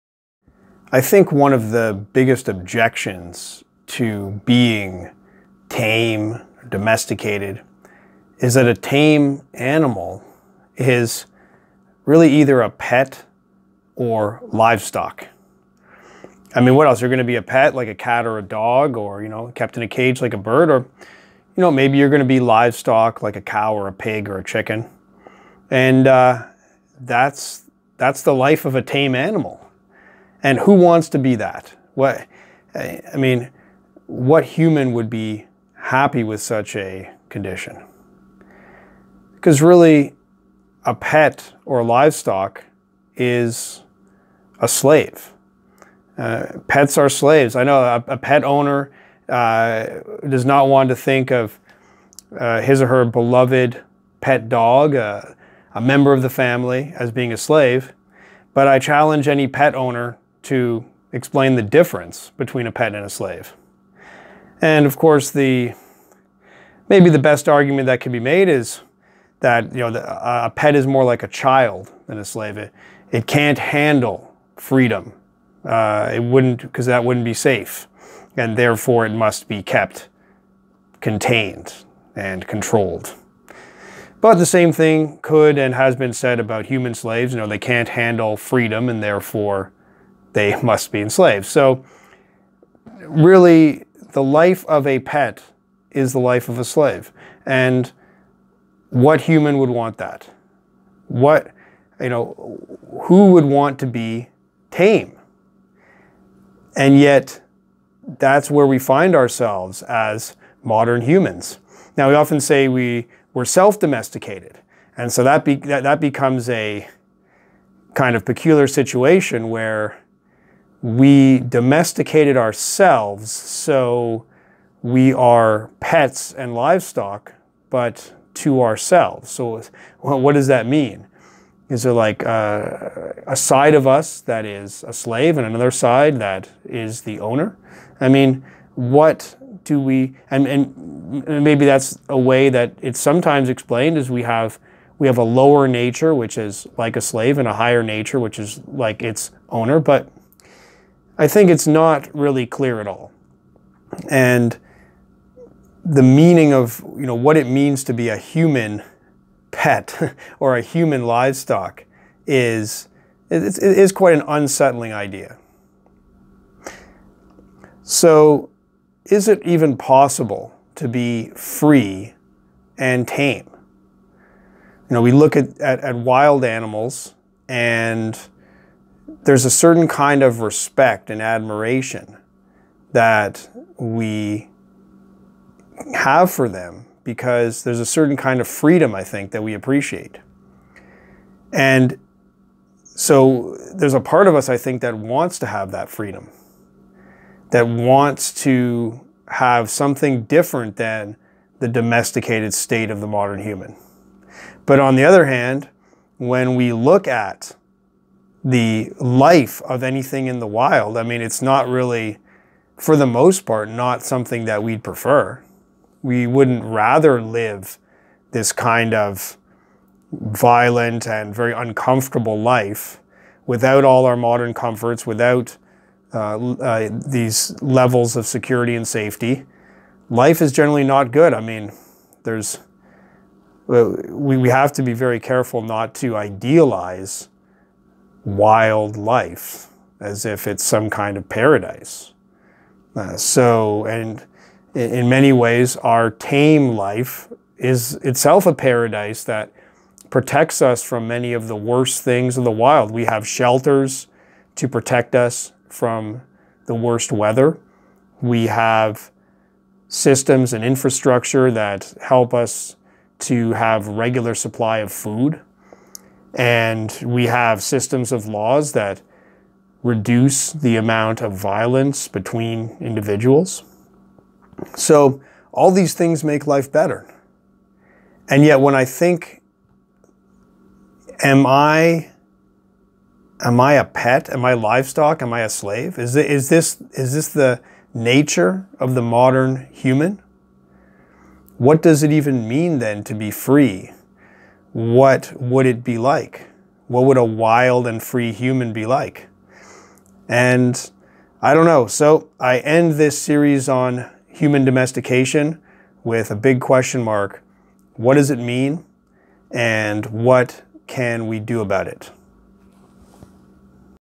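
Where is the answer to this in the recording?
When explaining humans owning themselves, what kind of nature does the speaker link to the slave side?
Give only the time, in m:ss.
2:25.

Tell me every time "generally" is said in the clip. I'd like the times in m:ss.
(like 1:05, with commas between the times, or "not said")
3:50.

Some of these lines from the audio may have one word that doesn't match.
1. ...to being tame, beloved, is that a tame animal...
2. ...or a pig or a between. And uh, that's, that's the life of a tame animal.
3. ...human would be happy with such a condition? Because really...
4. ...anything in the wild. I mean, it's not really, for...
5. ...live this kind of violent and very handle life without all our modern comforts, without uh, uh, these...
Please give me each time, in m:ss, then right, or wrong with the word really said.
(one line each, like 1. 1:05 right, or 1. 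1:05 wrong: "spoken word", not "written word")
1. 0:03 wrong: "domesticated", not "beloved"
2. 0:23 wrong: "chicken", not "between"
3. 0:34 right
4. 3:29 right
5. 3:37 wrong: "uncomfortable", not "handle".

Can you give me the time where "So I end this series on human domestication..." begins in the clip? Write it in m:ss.
5:01.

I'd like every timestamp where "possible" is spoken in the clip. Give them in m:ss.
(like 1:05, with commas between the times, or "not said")
2:49.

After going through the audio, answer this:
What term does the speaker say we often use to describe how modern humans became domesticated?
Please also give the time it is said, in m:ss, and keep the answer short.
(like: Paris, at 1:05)
self-domesticated, at 1:53.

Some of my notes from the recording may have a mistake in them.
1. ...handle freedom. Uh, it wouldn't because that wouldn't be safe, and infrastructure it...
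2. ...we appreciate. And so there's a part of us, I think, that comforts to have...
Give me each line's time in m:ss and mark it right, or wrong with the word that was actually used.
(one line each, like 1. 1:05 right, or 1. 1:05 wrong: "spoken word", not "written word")
1. 1:13 wrong: "therefore", not "infrastructure"
2. 3:09 wrong: "wants", not "comforts".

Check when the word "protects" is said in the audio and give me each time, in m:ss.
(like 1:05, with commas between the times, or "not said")
4:10, 4:14.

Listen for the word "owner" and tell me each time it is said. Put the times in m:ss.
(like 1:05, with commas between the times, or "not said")
0:48, 0:59, 2:17, 2:29.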